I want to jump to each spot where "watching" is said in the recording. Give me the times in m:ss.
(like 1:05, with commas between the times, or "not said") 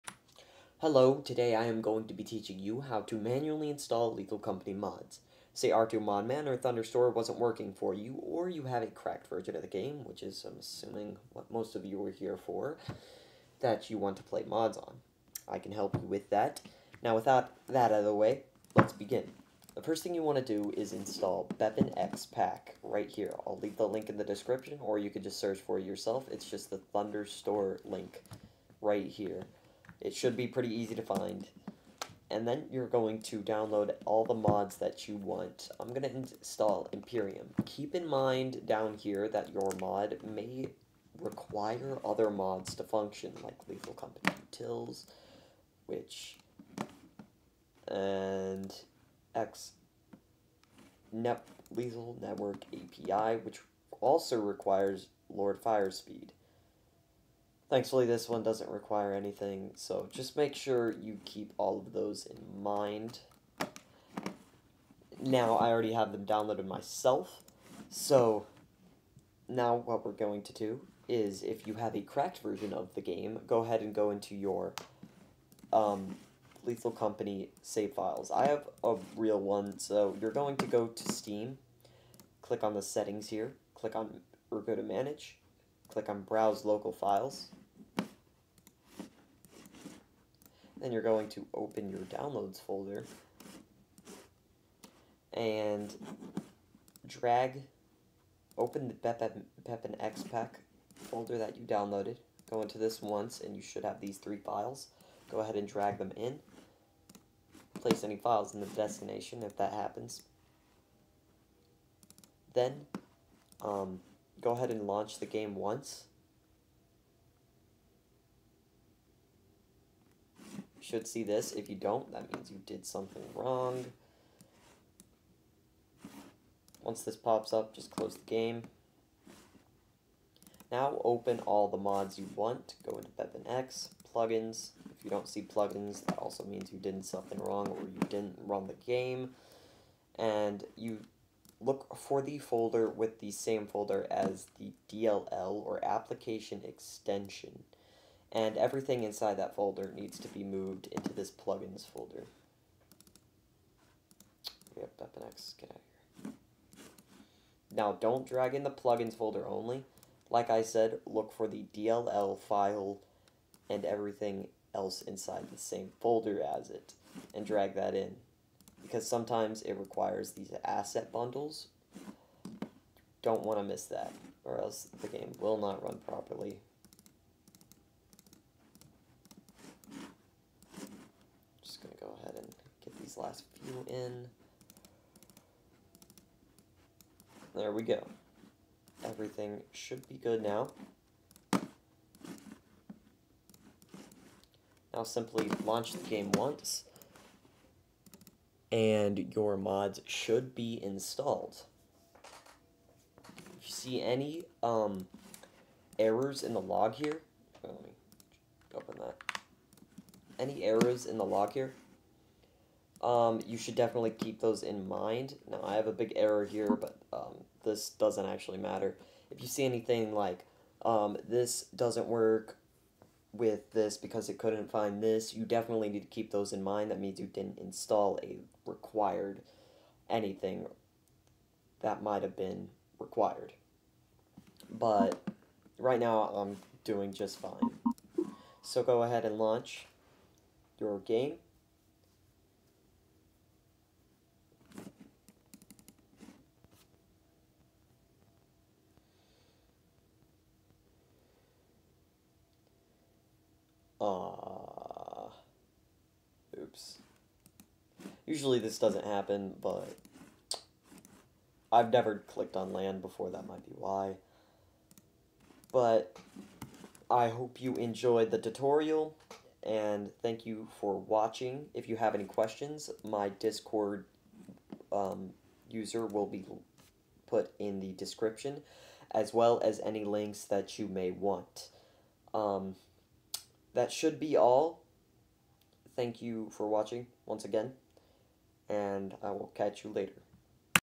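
4:30, 4:46.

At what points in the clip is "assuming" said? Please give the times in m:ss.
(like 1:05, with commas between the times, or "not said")
0:10.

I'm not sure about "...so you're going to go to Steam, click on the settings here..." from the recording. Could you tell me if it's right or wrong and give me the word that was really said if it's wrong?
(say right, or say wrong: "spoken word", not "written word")
right.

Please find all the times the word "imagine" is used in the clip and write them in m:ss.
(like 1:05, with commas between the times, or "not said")
not said.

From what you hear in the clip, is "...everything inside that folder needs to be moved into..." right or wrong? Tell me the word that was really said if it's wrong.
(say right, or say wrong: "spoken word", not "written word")
right.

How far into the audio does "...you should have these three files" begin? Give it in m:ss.
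1:43.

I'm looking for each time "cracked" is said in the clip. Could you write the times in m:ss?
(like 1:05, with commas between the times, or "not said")
0:08, 1:12.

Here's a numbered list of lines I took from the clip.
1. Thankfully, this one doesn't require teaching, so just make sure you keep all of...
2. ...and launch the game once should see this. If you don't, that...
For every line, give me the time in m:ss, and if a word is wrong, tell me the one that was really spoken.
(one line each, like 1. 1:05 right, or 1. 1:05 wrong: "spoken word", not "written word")
1. 0:57 wrong: "anything", not "teaching"
2. 1:54 right.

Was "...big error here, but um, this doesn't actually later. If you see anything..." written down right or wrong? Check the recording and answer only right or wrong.
wrong.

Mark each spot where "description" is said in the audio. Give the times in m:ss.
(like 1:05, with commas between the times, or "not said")
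0:24, 4:37.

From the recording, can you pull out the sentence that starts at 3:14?
Now simply launch the game once, and your mods should be installed.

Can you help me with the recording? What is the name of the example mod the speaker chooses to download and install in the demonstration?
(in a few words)
Imperium.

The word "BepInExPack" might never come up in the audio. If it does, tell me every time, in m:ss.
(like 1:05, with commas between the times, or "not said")
0:21, 1:39.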